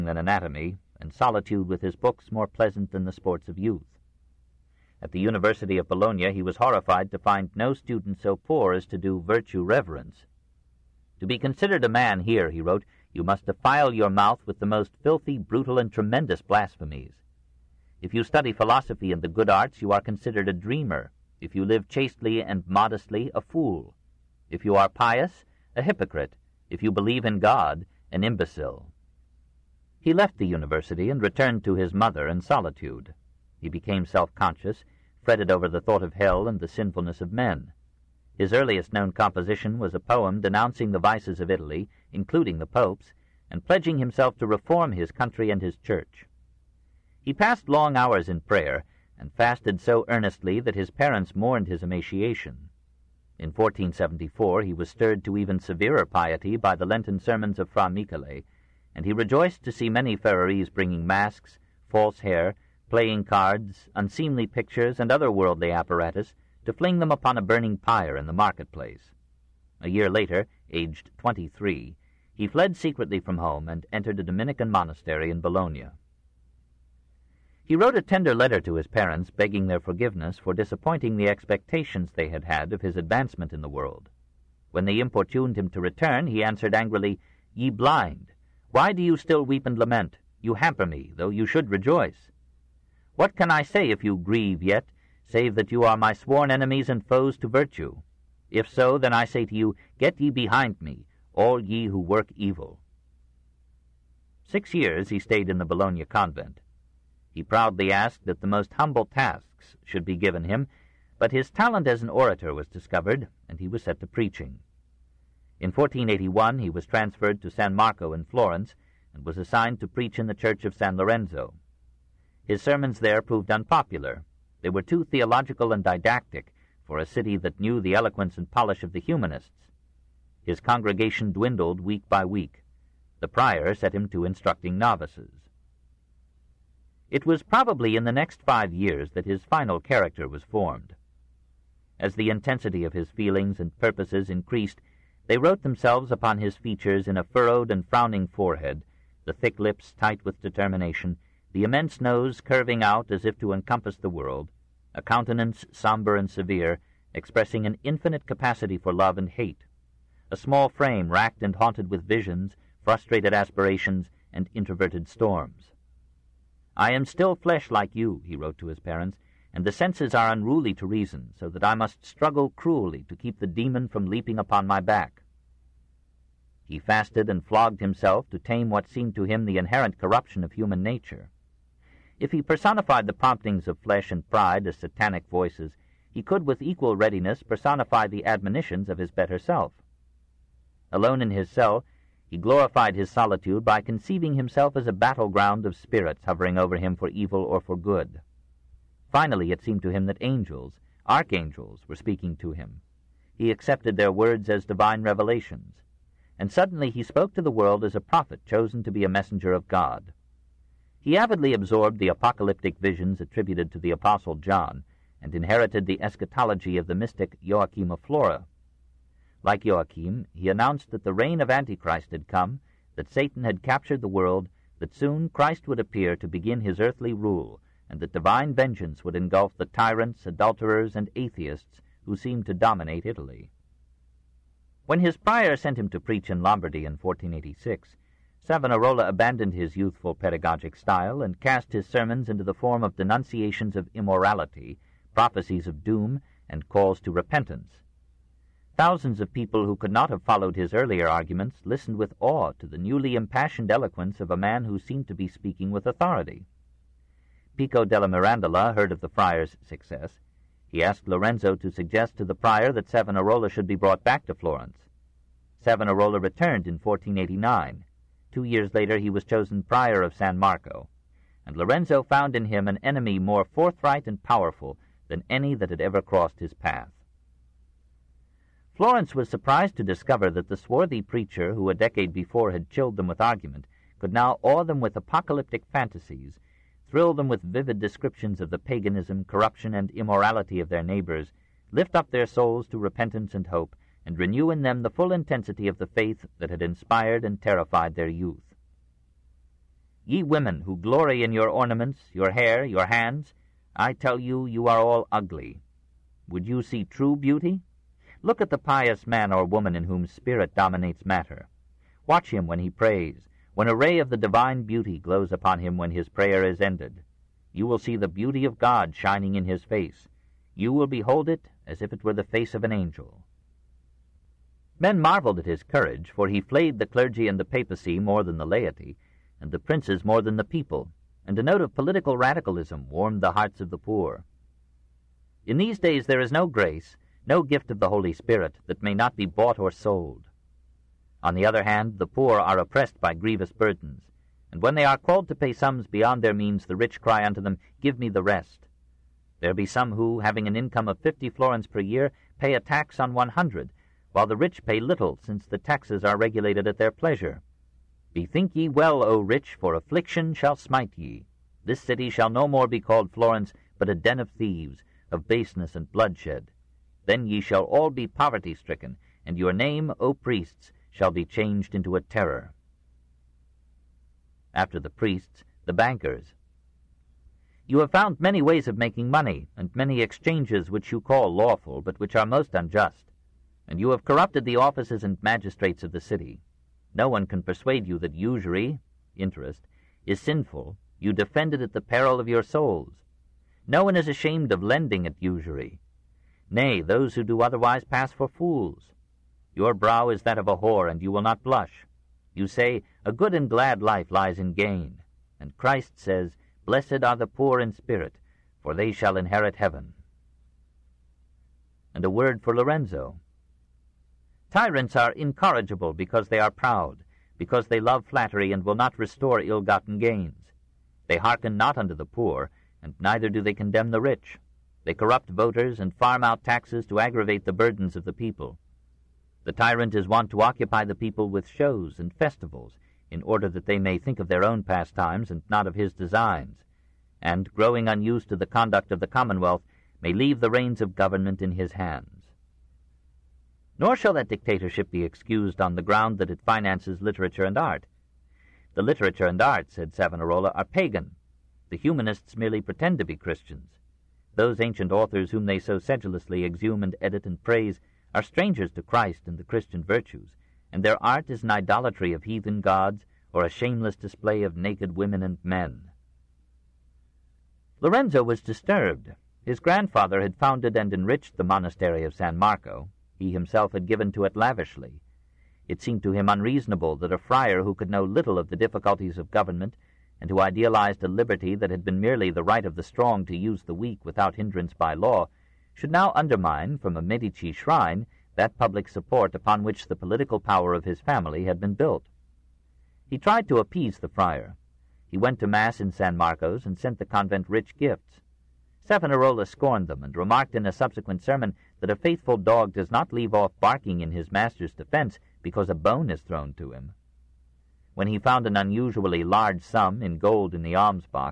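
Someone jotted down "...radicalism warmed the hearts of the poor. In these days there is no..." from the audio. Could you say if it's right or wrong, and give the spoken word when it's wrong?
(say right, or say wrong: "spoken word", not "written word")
right.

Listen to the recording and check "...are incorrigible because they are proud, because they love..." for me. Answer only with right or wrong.
right.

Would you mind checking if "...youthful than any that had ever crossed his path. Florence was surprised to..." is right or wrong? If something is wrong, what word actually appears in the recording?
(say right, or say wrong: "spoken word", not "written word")
wrong: "powerful", not "youthful".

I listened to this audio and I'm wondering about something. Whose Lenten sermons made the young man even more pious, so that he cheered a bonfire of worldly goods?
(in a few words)
Fra Michele.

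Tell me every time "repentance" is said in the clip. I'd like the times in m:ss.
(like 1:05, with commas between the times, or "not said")
4:07, 4:52.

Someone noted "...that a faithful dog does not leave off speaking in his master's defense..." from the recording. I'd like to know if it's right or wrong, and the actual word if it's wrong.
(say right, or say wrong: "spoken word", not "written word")
wrong: "barking", not "speaking".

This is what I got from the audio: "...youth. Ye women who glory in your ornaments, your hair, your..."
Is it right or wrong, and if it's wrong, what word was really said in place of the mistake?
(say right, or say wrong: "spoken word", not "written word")
right.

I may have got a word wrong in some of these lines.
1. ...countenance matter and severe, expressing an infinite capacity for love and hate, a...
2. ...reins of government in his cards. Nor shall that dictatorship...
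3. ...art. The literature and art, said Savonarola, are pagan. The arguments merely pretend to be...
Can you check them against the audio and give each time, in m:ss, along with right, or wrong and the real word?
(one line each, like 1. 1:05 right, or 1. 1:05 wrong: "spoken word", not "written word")
1. 2:35 wrong: "somber", not "matter"
2. 7:20 wrong: "hands", not "cards"
3. 7:27 wrong: "humanists", not "arguments".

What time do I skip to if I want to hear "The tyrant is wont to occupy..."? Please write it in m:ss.
7:09.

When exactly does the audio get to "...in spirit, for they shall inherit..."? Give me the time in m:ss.
6:47.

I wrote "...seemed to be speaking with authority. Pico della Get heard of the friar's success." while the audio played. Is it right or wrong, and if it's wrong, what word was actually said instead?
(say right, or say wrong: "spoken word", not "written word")
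wrong: "Mirandola", not "Get".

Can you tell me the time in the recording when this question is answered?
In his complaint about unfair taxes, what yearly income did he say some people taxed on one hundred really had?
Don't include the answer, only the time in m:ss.
5:50.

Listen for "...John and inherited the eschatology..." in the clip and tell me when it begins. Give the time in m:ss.
3:34.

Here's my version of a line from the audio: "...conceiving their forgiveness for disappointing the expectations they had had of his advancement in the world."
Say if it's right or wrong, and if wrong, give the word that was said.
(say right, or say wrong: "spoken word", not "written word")
wrong: "begging", not "conceiving".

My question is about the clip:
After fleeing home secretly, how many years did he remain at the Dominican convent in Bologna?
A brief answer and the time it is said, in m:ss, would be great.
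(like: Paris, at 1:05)
6, at 1:44.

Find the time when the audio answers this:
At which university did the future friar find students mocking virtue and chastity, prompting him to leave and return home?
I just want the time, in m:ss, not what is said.
0:05.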